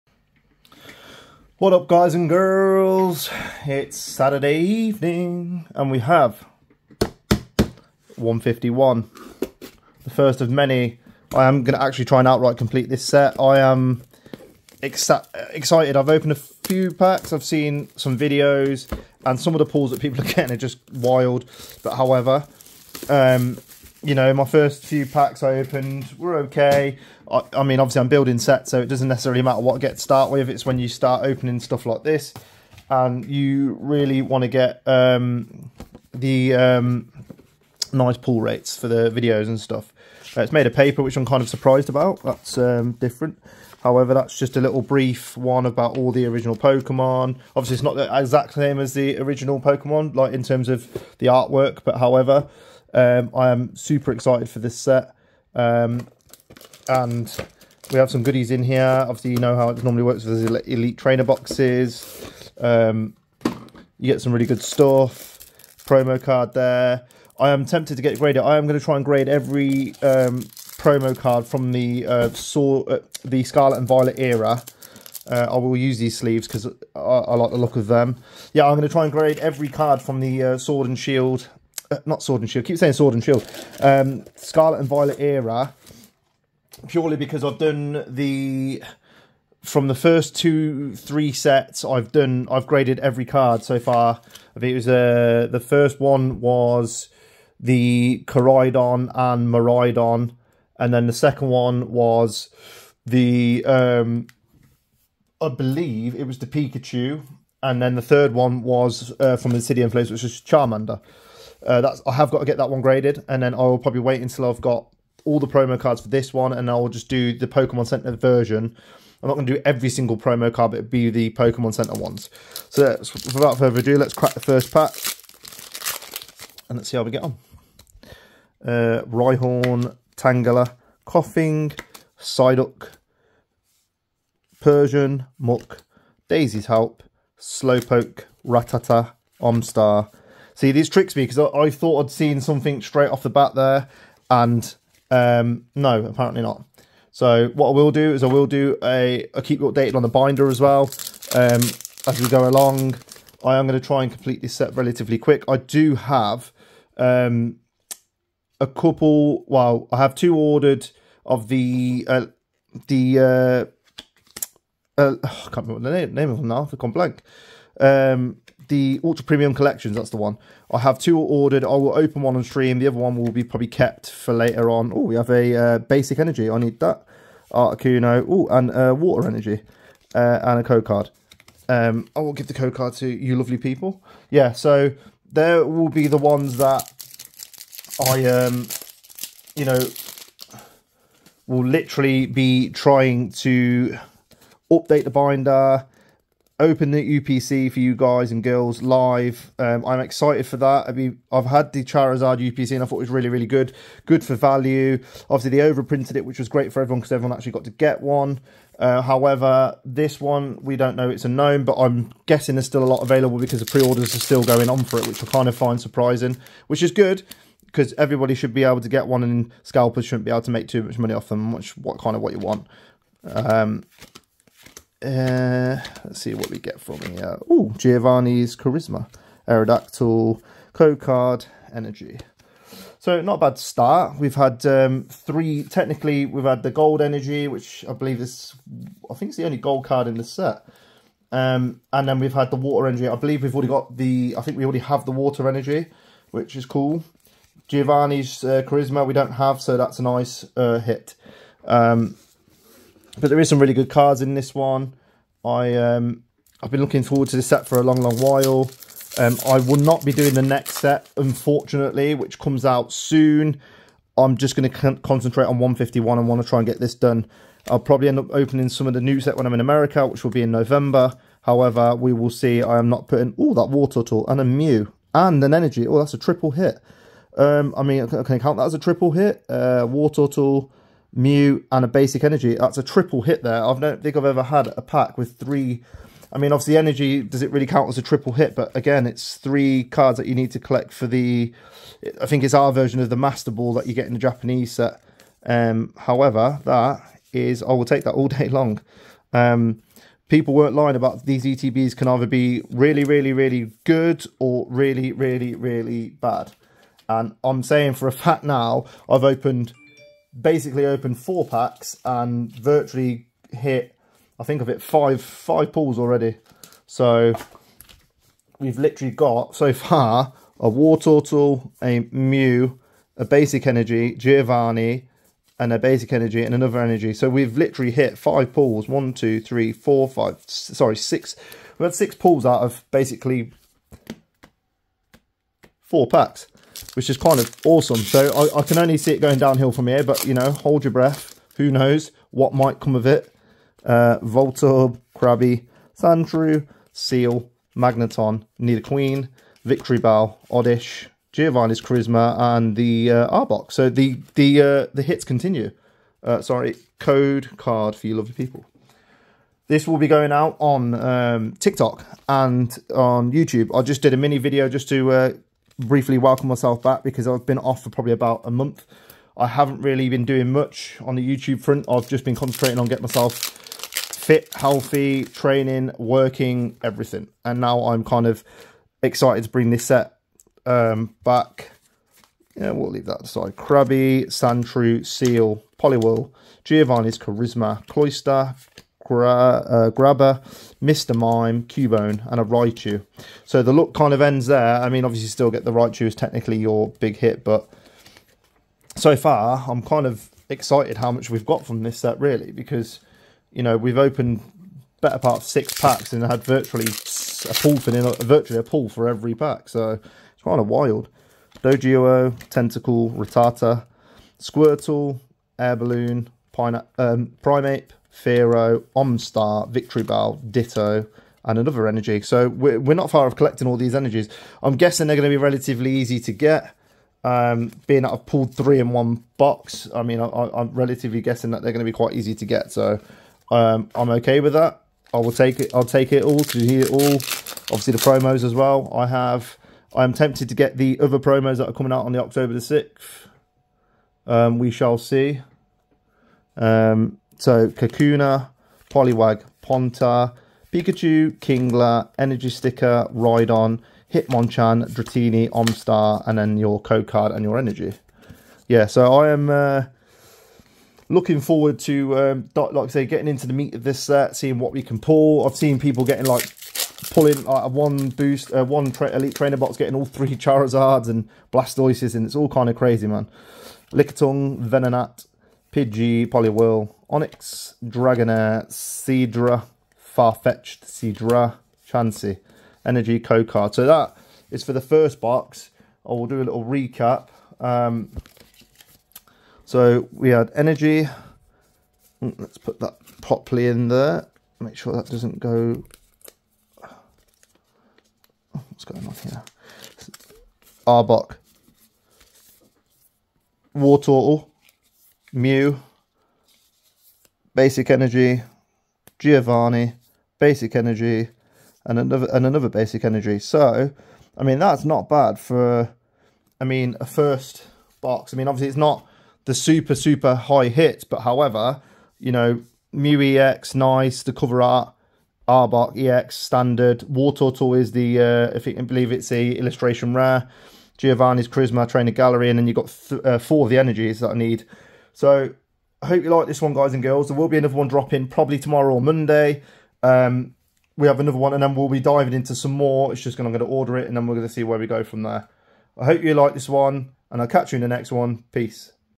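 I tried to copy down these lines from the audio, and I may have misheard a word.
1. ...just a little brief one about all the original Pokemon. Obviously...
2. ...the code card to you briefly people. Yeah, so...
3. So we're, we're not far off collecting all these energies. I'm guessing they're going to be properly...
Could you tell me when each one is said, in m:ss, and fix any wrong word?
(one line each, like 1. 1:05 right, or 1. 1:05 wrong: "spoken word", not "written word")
1. 0:44 right
2. 3:02 wrong: "lovely", not "briefly"
3. 7:02 wrong: "relatively", not "properly".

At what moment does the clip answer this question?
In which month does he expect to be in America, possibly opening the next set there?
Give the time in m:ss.
4:30.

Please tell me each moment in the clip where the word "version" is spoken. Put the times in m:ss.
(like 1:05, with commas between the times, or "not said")
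1:58, 4:52.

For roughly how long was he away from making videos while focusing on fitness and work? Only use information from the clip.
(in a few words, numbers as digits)
about a month.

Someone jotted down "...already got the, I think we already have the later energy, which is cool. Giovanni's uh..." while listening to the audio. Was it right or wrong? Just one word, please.
wrong.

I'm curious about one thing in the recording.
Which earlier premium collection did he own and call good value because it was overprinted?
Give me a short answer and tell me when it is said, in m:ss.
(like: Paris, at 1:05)
Charizard UPC, at 3:21.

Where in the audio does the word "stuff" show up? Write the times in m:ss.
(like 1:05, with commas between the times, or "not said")
0:31, 0:39, 1:04.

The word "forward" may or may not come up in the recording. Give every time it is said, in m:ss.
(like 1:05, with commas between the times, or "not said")
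4:17, 7:41.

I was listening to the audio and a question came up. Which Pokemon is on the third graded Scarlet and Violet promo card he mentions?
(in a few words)
Charmander.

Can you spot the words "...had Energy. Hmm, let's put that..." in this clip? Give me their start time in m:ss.
8:10.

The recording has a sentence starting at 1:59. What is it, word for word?
I'm not going to do every single promo card, but it'd be the Pokemon Center ones.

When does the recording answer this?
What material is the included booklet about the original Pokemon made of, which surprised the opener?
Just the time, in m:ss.
0:40.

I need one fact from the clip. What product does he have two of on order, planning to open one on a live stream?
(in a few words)
Ultra Premium Collections.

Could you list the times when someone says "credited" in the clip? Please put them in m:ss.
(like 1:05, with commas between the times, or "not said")
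not said.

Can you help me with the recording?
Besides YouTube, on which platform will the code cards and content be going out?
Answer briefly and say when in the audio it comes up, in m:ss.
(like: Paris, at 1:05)
TikTok, at 6:01.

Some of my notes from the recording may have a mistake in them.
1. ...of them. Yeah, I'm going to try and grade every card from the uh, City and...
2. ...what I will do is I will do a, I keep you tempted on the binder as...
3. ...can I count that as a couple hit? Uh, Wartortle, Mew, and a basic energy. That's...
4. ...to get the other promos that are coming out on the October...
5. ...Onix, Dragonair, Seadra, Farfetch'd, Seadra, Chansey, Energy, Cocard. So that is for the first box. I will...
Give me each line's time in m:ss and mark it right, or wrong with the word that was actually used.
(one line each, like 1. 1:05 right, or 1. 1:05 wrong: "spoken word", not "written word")
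1. 1:17 wrong: "Sword", not "City"
2. 2:27 wrong: "updated", not "tempted"
3. 4:38 wrong: "triple", not "couple"
4. 7:20 right
5. 7:57 right.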